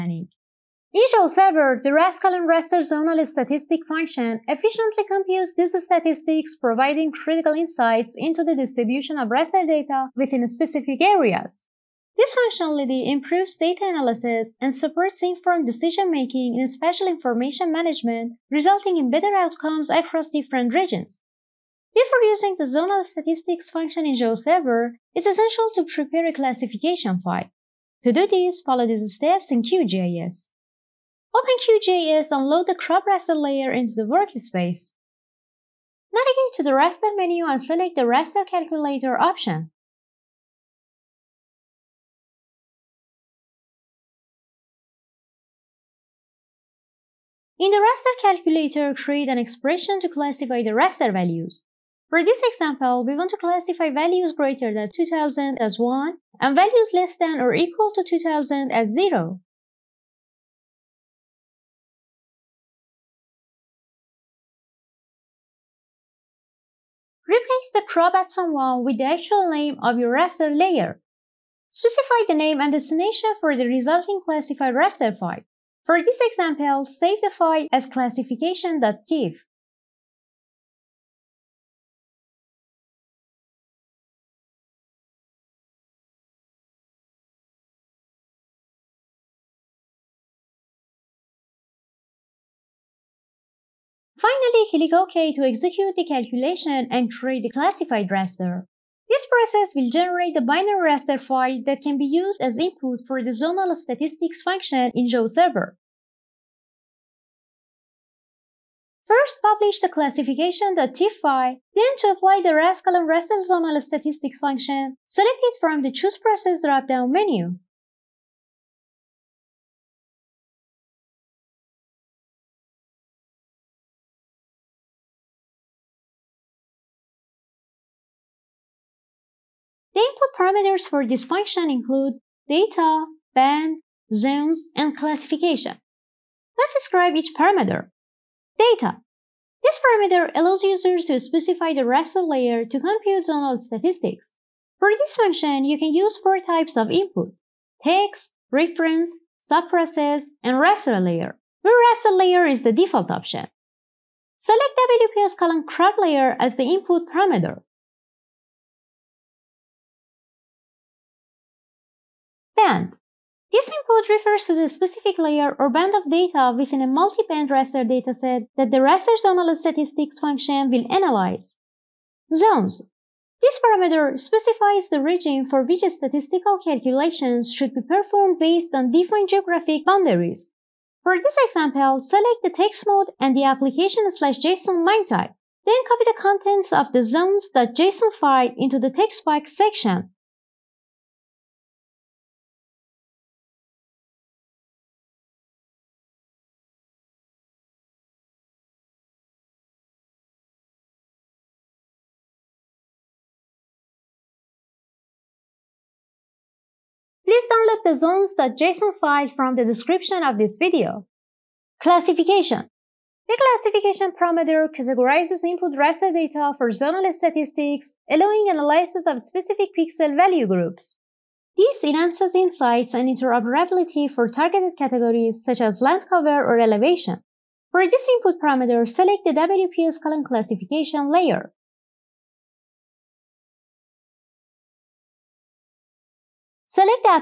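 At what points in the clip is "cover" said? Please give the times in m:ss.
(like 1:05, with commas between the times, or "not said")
3:46.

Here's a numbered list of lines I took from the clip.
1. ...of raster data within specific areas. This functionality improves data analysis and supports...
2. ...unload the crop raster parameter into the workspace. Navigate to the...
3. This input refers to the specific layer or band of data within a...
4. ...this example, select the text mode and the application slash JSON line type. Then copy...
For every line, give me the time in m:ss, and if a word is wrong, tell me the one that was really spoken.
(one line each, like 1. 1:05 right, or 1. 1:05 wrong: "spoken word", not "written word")
1. 0:09 right
2. 0:32 wrong: "layer", not "parameter"
3. 2:43 right
4. 3:01 right.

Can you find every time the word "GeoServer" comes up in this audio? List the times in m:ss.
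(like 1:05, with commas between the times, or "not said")
0:24, 1:45.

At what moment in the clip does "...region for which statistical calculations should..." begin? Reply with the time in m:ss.
2:55.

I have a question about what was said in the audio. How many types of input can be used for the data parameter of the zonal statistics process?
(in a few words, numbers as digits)
4.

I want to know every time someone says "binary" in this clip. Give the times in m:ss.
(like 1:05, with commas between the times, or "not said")
1:40.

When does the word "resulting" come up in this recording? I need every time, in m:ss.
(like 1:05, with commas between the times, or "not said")
0:18, 1:13.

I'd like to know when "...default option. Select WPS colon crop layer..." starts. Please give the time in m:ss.
2:32.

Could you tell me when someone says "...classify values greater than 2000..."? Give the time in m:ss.
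0:53.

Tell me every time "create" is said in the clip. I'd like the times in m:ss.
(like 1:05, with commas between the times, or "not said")
0:48, 1:37.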